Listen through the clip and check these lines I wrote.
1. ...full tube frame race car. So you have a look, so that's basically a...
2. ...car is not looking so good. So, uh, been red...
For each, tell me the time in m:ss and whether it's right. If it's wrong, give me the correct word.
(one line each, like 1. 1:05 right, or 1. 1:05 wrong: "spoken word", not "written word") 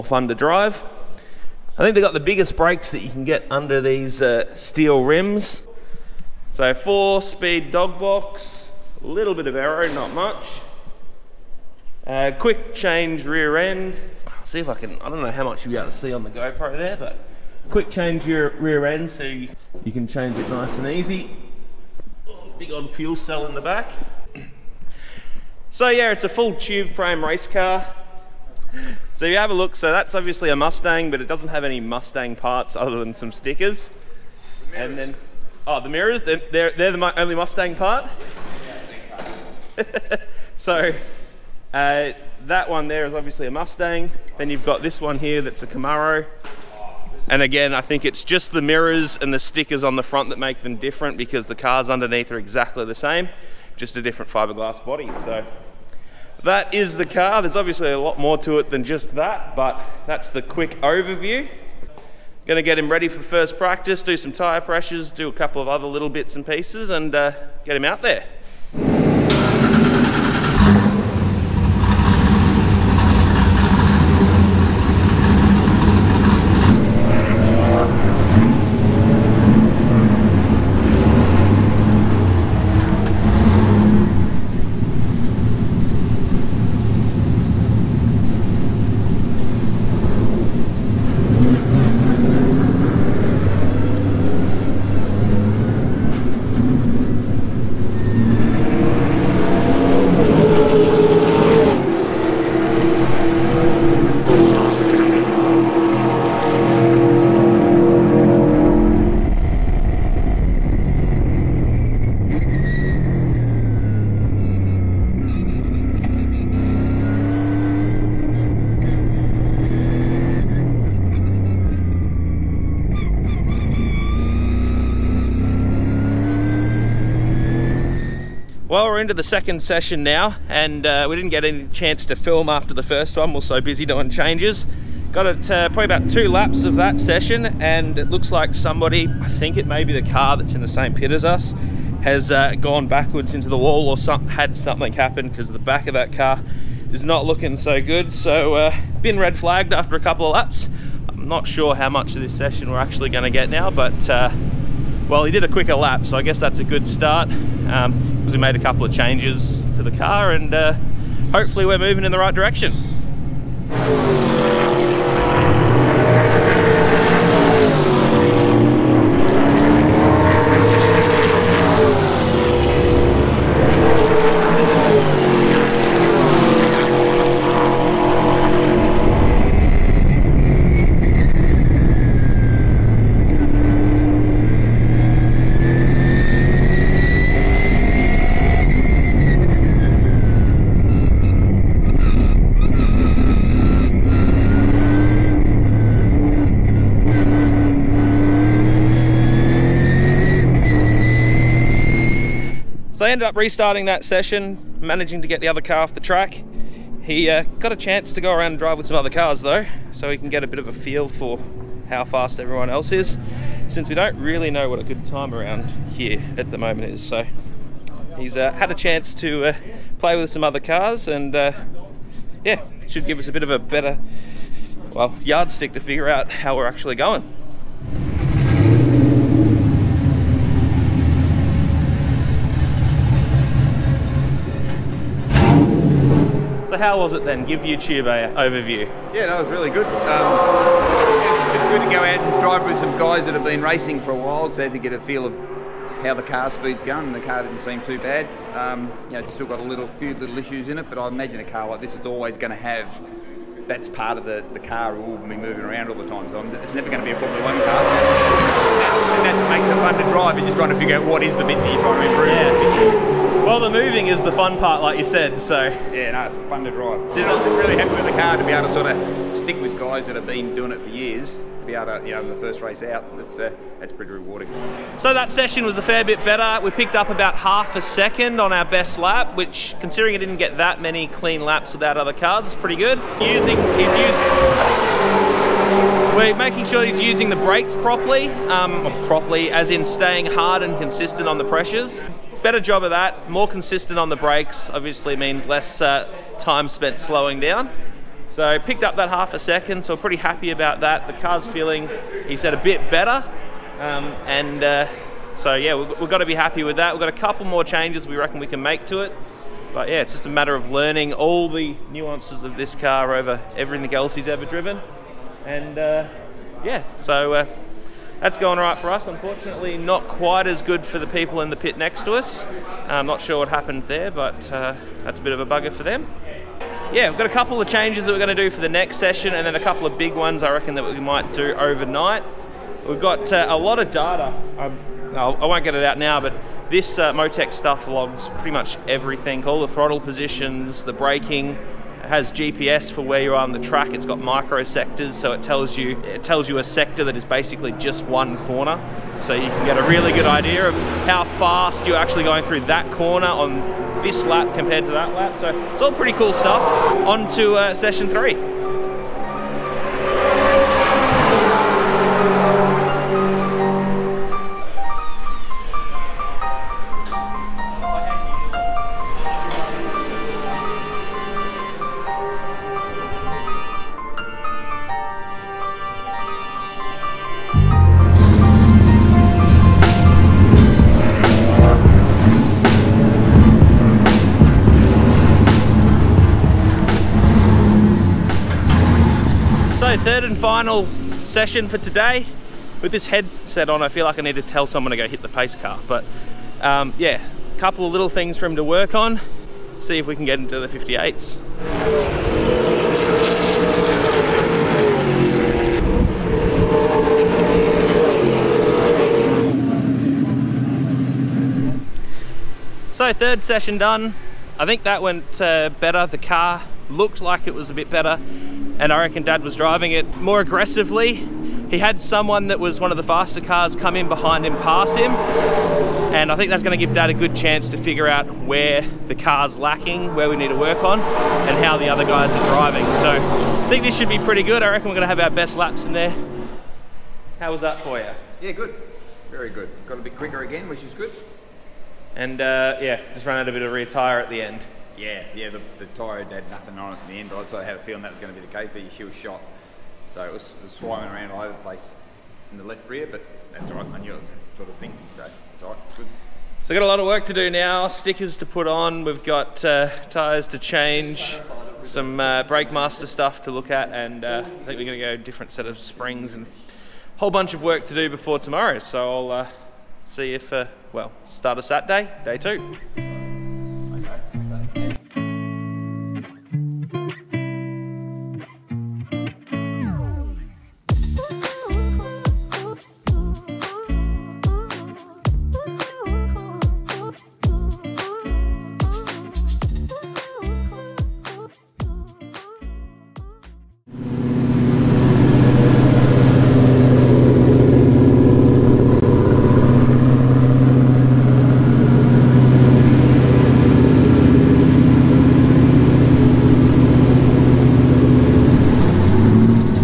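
1. 0:26 wrong: "obviously", not "basically"
2. 2:26 right.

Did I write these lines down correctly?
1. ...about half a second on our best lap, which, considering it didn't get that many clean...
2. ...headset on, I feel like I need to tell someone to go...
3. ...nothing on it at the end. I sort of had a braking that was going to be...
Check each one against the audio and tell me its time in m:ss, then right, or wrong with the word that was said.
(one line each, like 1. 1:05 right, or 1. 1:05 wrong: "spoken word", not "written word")
1. 4:37 right
2. 6:33 right
3. 7:26 wrong: "feeling", not "braking".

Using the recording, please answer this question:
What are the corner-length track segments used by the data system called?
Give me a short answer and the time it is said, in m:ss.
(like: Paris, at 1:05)
Micro sectors, at 5:44.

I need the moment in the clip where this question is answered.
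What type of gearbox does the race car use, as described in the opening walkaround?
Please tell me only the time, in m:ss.
0:06.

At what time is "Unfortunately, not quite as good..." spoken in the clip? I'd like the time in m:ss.
5:19.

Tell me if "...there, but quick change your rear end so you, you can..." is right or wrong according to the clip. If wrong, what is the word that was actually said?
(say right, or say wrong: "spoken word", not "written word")
right.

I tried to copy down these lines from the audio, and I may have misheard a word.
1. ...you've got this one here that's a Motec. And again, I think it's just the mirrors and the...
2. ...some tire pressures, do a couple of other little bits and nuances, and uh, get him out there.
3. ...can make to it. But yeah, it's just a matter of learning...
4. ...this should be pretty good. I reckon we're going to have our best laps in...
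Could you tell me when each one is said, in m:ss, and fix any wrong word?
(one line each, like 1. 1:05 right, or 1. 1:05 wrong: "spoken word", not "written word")
1. 0:44 wrong: "Camaro", not "Motec"
2. 1:04 wrong: "pieces", not "nuances"
3. 5:08 right
4. 7:13 right.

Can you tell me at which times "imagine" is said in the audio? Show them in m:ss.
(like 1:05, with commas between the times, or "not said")
4:11.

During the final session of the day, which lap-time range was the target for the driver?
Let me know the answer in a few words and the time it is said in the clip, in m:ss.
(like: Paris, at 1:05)
The 58s, at 6:40.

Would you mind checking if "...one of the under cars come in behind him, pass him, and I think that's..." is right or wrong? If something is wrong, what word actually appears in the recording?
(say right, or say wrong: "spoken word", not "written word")
wrong: "faster", not "under".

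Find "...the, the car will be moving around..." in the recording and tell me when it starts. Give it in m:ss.
4:14.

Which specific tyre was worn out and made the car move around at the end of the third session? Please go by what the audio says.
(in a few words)
Left rear.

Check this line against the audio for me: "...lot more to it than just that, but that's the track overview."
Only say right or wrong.
wrong.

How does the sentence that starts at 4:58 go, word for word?
So picked up that half a second, so pretty happy about that.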